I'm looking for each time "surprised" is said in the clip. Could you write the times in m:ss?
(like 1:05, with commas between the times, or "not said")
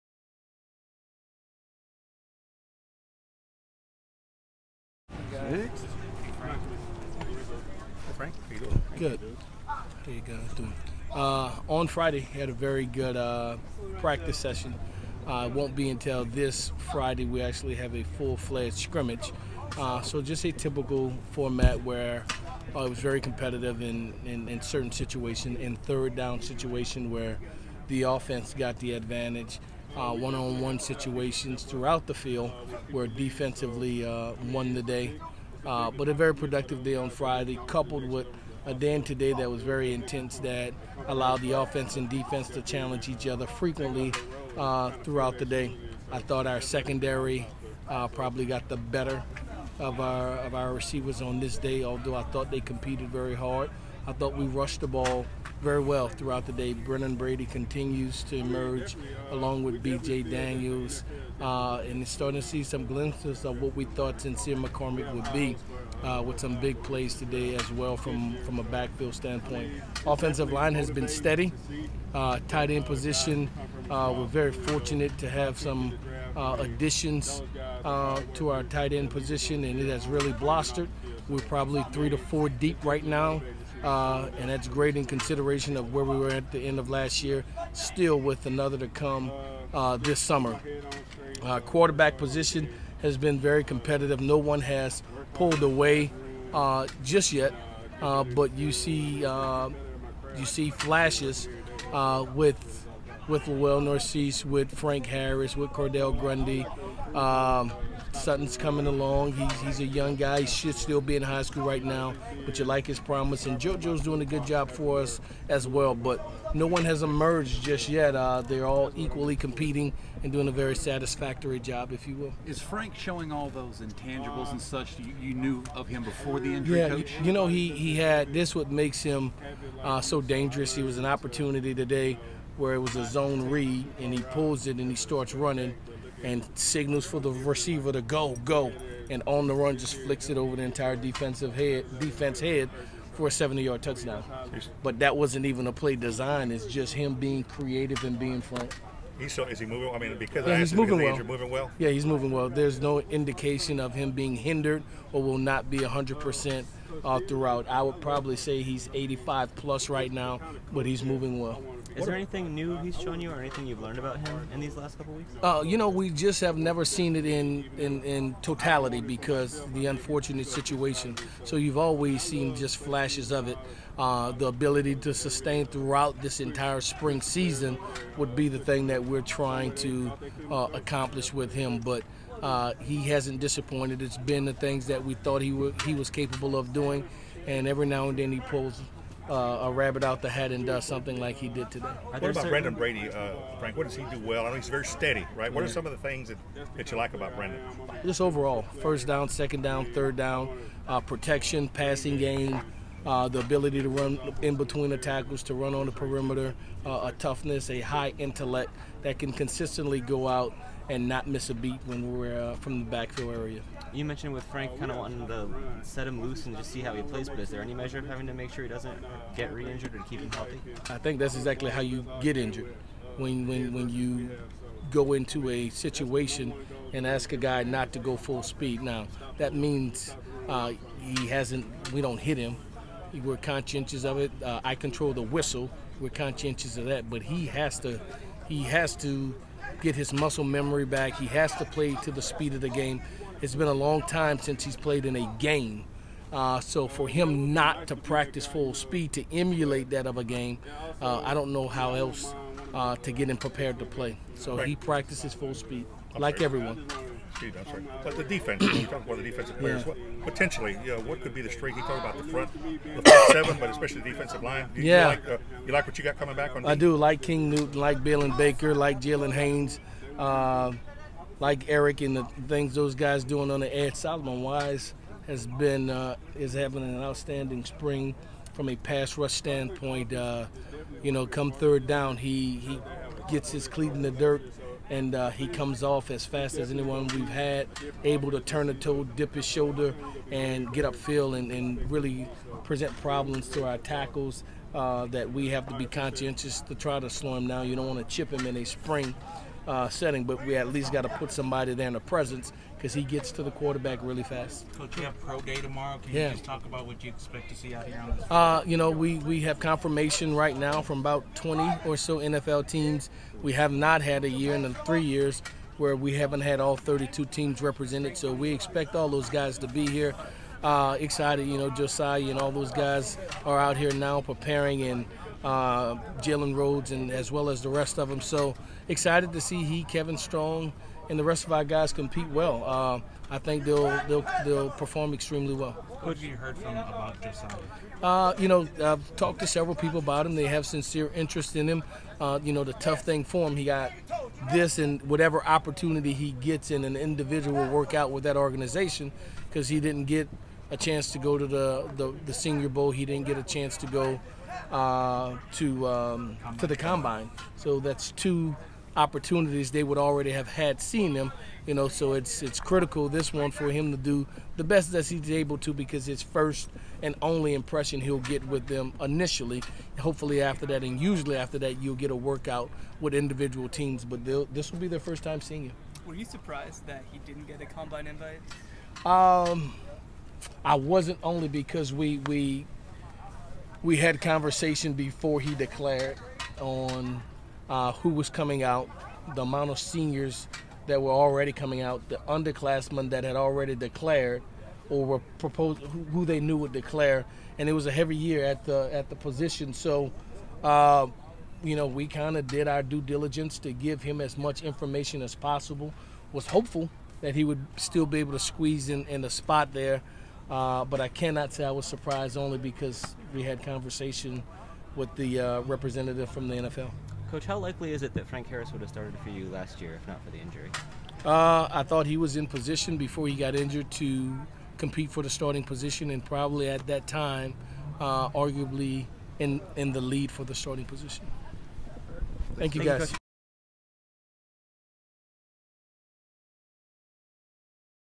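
6:16, 6:51.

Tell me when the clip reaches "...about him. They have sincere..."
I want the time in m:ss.
5:39.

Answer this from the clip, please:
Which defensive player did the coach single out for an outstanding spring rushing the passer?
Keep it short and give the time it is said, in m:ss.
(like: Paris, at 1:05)
Solomon Wise, at 4:33.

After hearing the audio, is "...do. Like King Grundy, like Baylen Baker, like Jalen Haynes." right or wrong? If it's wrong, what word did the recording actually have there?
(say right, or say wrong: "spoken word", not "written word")
wrong: "Newton", not "Grundy".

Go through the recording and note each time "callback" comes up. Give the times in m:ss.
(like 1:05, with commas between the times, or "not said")
not said.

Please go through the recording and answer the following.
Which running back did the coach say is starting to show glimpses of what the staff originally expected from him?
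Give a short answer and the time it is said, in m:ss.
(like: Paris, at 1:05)
Sincere McCormick, at 1:04.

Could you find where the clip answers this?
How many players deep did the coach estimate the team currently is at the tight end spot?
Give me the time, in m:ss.
1:21.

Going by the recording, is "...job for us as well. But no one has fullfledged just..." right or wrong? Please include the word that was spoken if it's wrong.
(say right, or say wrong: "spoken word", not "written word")
wrong: "emerged", not "fullfledged".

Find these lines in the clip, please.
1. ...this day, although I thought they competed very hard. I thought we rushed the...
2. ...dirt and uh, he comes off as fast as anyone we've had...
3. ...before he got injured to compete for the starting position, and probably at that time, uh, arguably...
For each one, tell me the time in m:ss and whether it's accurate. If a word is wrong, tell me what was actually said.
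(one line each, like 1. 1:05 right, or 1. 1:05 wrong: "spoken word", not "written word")
1. 0:51 right
2. 4:44 right
3. 7:02 right.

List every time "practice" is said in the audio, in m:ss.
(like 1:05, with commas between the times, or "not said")
0:13, 4:07, 4:14.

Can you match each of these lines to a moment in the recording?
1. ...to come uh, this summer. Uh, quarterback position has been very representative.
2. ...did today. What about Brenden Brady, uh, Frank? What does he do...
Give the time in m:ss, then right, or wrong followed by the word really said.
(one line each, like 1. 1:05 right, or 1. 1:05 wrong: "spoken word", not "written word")
1. 1:28 wrong: "competitive", not "representative"
2. 3:11 right.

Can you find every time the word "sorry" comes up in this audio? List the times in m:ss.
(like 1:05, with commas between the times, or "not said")
4:17.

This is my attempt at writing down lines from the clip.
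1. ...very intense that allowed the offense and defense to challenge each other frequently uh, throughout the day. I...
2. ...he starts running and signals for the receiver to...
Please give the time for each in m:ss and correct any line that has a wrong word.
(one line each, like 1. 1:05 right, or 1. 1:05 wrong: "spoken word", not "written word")
1. 0:39 right
2. 2:14 right.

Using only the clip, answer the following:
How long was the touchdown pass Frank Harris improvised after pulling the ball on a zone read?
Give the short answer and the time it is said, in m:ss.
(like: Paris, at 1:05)
70 yards, at 2:23.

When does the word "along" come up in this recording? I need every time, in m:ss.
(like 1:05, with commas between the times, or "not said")
0:59, 1:48.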